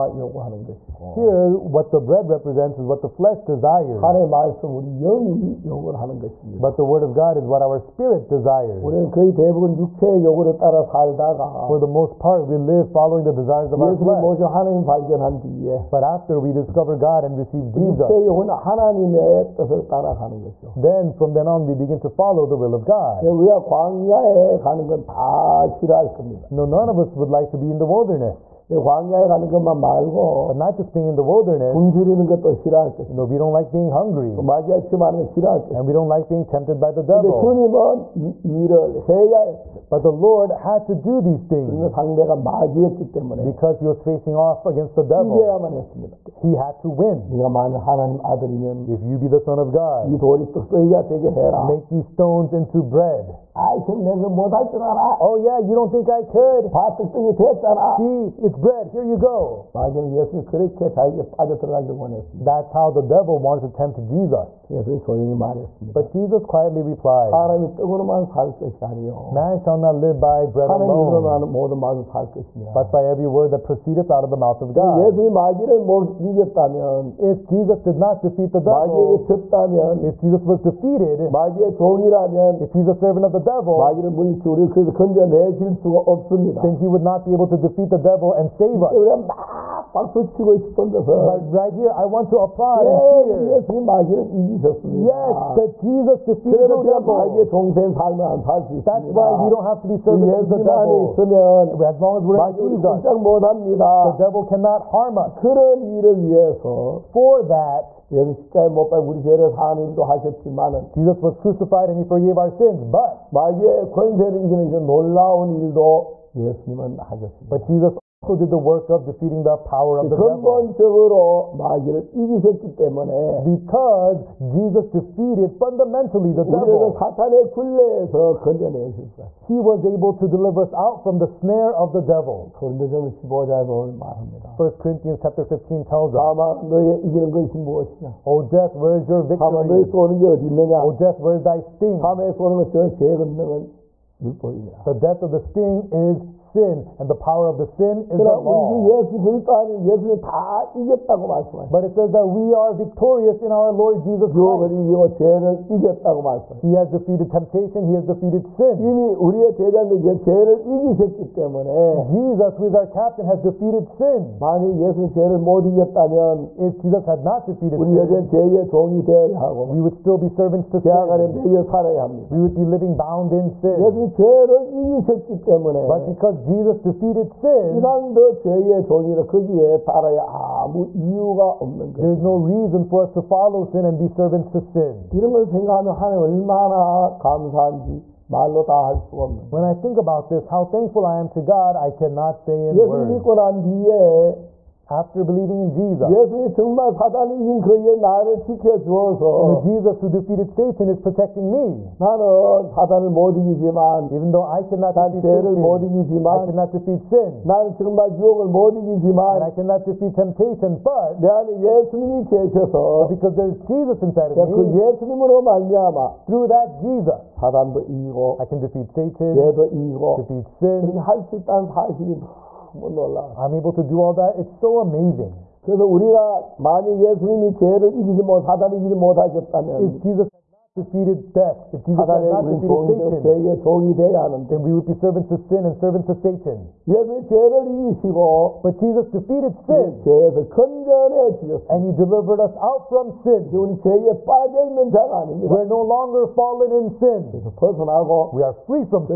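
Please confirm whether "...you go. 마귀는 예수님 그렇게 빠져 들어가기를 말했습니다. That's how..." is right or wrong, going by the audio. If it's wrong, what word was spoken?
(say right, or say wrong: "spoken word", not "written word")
wrong: "원했습니다", not "말했습니다".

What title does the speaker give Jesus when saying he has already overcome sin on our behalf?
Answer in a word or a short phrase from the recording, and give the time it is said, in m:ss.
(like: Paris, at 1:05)
Captain, at 2:42.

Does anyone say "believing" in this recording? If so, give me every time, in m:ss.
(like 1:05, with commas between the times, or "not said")
3:15.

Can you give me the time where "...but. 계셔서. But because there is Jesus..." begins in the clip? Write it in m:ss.
3:30.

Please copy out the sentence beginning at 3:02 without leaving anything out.
There's no reason for us to follow sin and be servants to sin.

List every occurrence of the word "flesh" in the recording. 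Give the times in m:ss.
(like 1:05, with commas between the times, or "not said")
0:03, 0:14.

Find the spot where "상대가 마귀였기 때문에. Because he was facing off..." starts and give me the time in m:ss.
0:41.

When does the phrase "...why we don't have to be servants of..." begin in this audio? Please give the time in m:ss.
1:39.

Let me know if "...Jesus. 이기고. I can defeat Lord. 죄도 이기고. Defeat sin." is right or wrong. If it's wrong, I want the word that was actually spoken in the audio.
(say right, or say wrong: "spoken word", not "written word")
wrong: "Satan", not "Lord".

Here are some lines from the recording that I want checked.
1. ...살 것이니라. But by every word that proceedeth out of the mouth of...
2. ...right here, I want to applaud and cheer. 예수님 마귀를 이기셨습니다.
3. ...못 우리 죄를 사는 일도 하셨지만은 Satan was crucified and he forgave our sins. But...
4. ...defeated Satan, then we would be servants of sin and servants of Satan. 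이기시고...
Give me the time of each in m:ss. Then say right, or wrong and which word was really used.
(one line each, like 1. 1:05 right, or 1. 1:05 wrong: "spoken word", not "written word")
1. 1:12 right
2. 1:31 right
3. 1:48 wrong: "Jesus", not "Satan"
4. 3:52 right.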